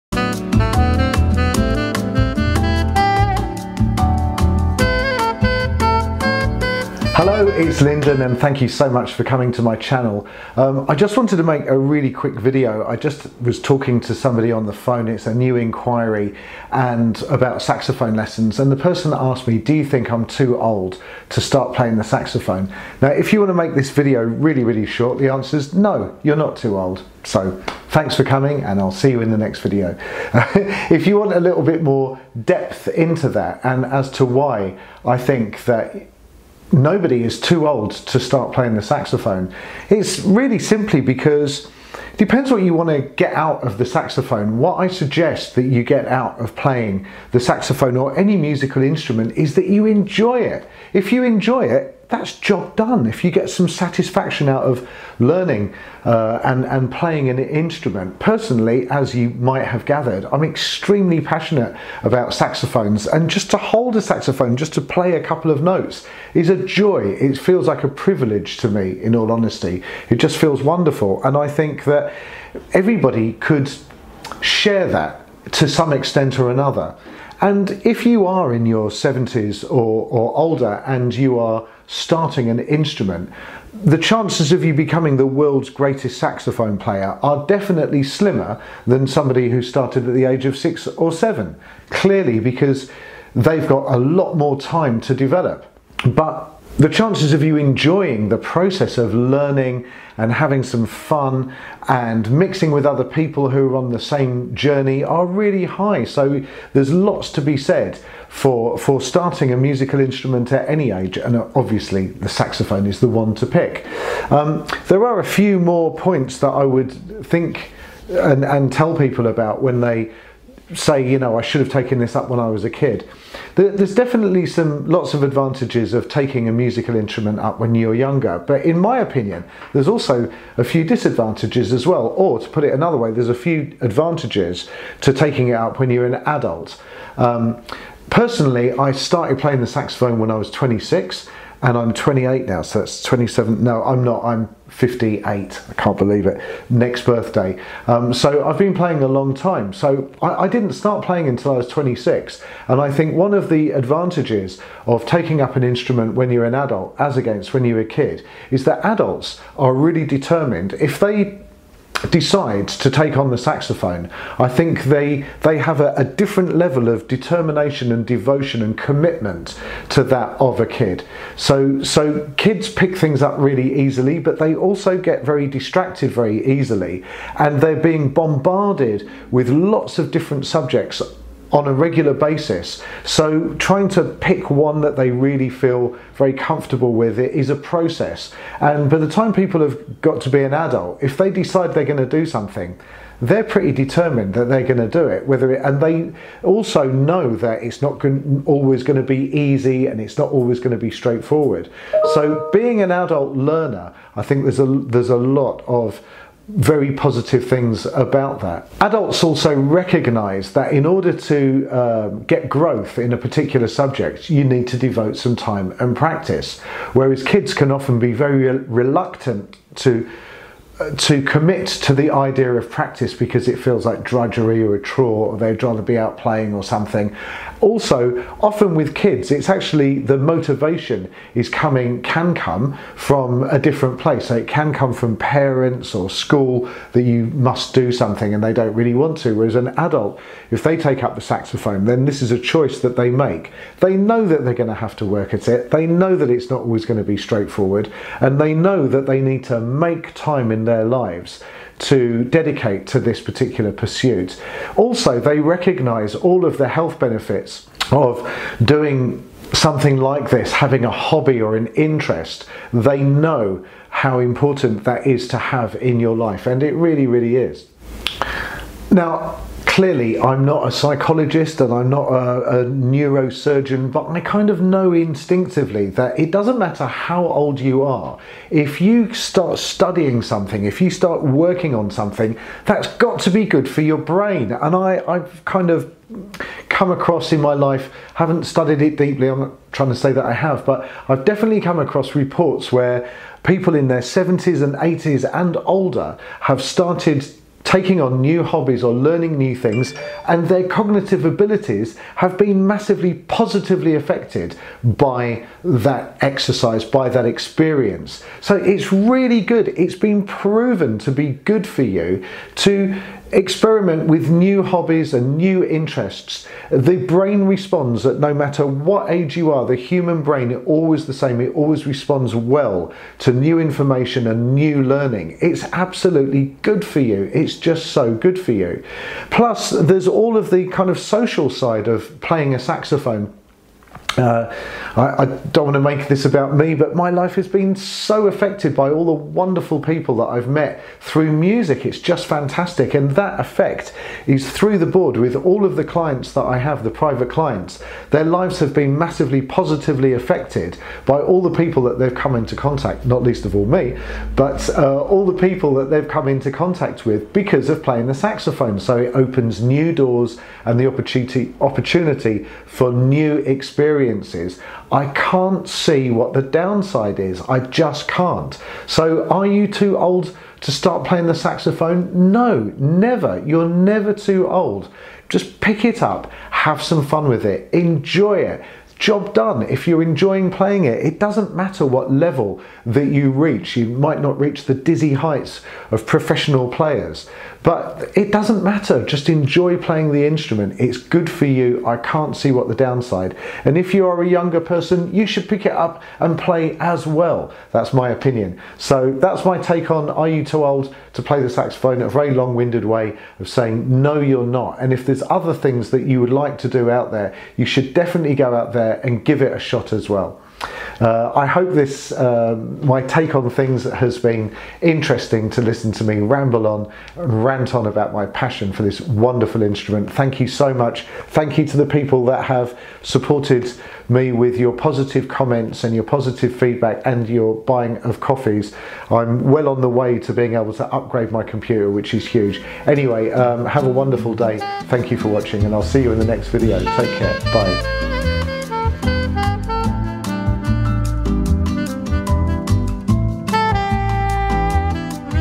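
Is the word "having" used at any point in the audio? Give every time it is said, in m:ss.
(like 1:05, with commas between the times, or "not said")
1:40, 4:20.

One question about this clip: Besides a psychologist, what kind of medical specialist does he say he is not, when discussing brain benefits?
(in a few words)
neurosurgeon.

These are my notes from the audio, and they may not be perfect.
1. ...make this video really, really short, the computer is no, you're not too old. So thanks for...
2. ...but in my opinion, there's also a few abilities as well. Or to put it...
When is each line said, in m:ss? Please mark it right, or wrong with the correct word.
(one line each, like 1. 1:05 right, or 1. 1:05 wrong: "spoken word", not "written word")
1. 0:23 wrong: "answer", not "computer"
2. 2:08 wrong: "disadvantages", not "abilities".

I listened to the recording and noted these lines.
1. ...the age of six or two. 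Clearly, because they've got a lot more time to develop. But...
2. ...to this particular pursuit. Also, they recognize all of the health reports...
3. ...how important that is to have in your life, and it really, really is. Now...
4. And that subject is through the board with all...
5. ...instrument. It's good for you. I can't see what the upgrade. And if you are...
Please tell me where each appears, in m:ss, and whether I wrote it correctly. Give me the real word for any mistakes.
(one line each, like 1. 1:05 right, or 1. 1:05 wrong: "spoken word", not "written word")
1. 1:30 wrong: "seven", not "two"
2. 4:12 wrong: "benefits", not "reports"
3. 4:23 right
4. 5:42 wrong: "effect", not "subject"
5. 6:30 wrong: "downside", not "upgrade".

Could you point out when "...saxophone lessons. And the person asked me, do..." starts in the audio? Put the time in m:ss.
0:17.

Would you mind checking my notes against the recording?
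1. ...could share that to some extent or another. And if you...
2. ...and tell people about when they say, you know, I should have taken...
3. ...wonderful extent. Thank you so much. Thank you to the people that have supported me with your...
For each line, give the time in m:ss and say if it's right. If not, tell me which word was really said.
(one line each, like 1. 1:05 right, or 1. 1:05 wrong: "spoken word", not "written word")
1. 1:13 right
2. 1:58 right
3. 6:59 wrong: "instrument", not "extent".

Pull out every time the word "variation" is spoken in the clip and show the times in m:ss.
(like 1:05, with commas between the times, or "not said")
not said.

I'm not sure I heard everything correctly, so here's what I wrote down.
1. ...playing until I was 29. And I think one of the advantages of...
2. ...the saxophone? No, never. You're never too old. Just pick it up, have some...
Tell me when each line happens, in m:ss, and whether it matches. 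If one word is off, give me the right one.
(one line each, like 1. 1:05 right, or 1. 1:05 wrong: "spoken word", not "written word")
1. 2:31 wrong: "26", not "29"
2. 6:11 right.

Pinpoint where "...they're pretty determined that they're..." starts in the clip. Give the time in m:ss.
3:13.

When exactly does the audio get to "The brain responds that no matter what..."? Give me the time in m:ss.
5:16.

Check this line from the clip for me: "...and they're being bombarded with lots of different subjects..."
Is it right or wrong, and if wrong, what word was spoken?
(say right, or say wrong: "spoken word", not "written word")
right.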